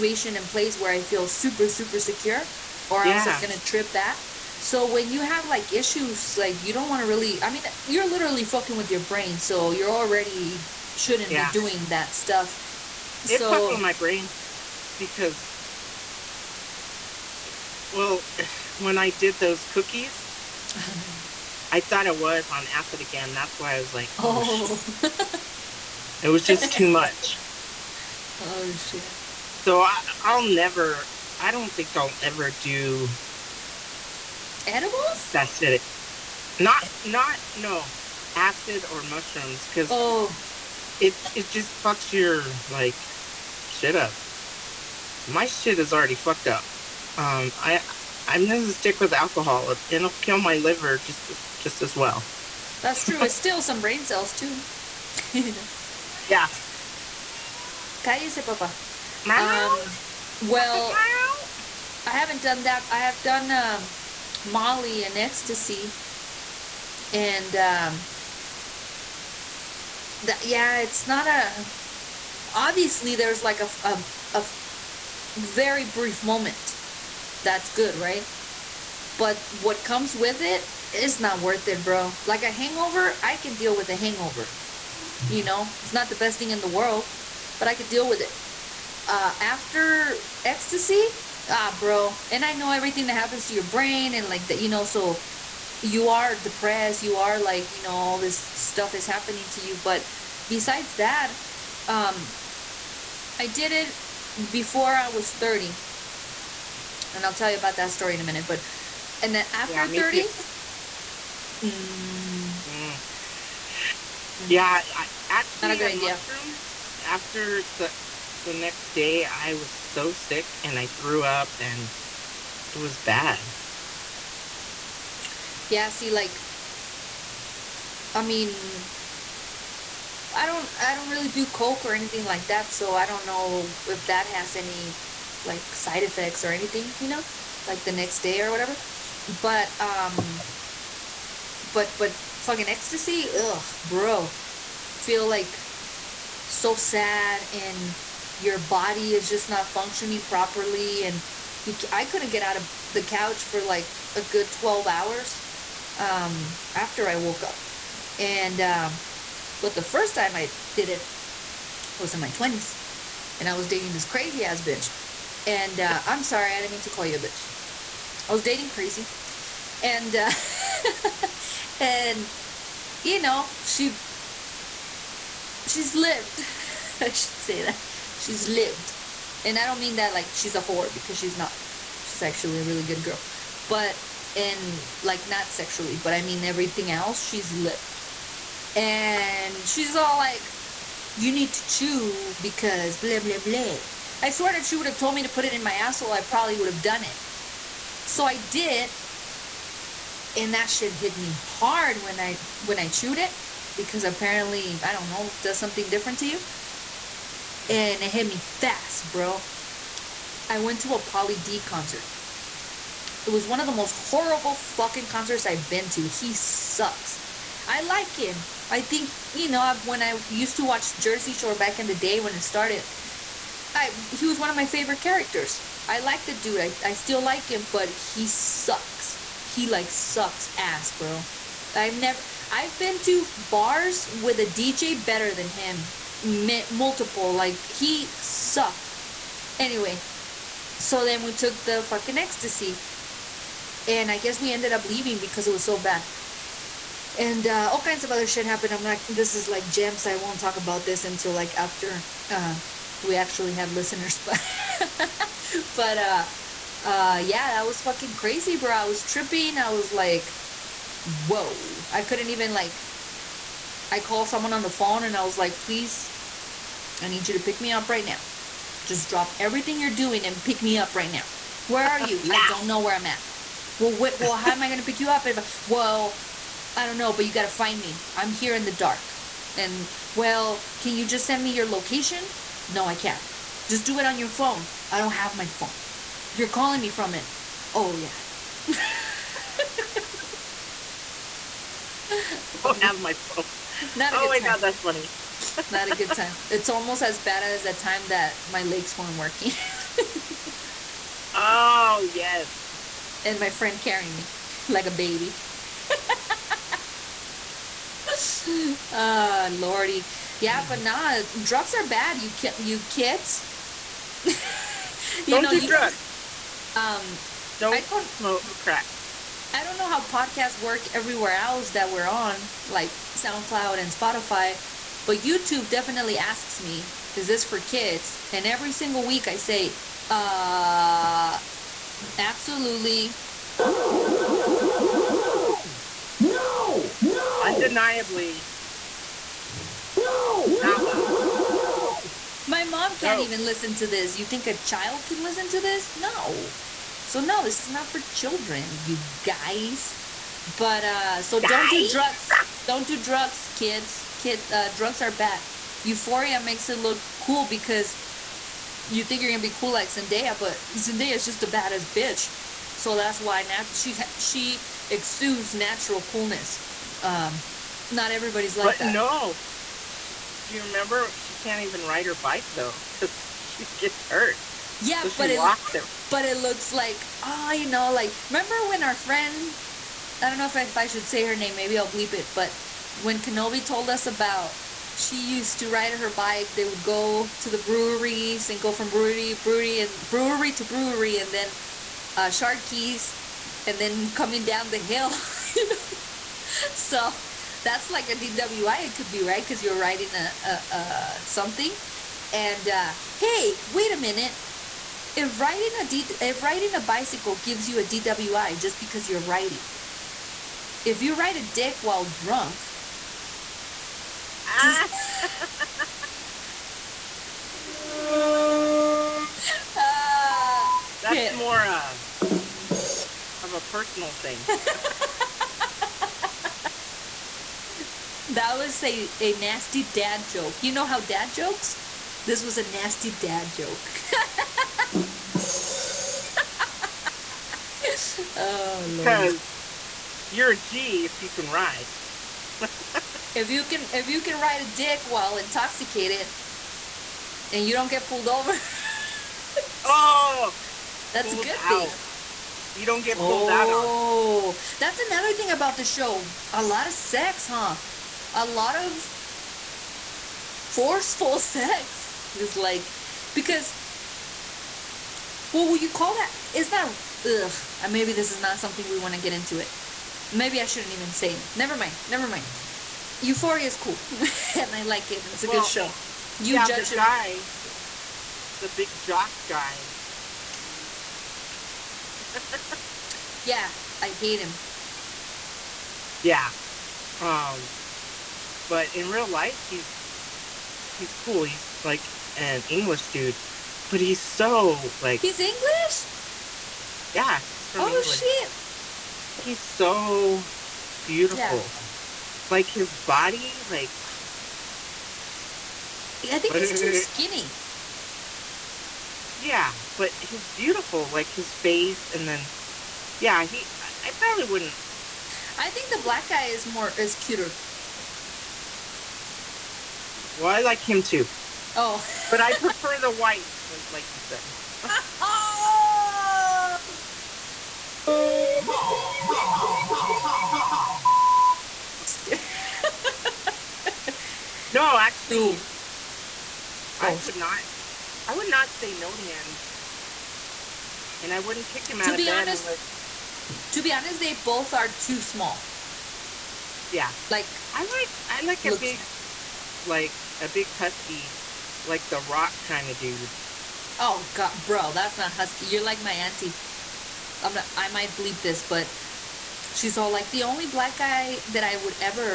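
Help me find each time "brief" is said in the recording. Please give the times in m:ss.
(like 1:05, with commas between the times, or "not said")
1:15.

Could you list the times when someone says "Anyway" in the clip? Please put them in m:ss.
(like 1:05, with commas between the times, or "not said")
3:59.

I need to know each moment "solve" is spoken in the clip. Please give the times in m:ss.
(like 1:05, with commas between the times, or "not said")
not said.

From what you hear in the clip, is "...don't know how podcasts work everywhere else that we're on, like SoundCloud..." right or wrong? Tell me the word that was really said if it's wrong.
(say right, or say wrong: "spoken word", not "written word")
right.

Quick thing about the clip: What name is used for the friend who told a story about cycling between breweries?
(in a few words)
Kenobi.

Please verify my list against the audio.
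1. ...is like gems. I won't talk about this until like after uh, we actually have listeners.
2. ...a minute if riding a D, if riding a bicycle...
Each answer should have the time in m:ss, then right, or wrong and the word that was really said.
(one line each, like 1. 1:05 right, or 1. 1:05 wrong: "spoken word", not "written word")
1. 4:09 right
2. 6:43 right.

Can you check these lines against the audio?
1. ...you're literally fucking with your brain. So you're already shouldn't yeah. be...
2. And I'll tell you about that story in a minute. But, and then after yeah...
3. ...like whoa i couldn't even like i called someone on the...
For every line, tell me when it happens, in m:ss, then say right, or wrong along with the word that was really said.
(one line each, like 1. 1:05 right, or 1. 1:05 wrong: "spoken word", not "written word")
1. 0:07 right
2. 1:47 right
3. 4:19 right.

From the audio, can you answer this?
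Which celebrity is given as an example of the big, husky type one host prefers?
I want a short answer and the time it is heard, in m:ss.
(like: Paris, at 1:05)
The Rock, at 9:12.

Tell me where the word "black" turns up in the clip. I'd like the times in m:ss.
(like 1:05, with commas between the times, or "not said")
8:36, 9:20.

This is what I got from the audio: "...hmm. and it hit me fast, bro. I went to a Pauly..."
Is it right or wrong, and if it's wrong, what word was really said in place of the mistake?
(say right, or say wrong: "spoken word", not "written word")
right.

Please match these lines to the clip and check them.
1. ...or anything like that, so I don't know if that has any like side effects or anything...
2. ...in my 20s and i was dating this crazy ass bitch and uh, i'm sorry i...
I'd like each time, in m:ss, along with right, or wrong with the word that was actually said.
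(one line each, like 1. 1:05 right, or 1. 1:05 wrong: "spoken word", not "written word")
1. 2:11 right
2. 2:42 right.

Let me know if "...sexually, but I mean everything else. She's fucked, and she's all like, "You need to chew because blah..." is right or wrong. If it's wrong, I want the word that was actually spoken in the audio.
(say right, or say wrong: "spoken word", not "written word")
wrong: "lived", not "fucked".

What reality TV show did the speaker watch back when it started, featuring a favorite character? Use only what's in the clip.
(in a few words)
Jersey Shore.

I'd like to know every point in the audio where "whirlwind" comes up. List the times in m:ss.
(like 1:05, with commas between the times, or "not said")
not said.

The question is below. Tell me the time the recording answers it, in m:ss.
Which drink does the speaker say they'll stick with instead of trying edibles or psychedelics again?
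0:49.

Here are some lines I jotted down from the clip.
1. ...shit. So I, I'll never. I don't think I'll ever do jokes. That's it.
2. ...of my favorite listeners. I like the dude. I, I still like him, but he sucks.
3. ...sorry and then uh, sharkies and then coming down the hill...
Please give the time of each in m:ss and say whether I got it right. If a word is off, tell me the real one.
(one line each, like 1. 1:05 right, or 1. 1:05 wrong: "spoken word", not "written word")
1. 0:28 wrong: "edibles", not "jokes"
2. 3:44 wrong: "characters", not "listeners"
3. 6:30 wrong: "brewery", not "sorry".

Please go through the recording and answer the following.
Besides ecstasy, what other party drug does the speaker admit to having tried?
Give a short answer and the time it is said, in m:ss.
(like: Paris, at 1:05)
Molly, at 1:04.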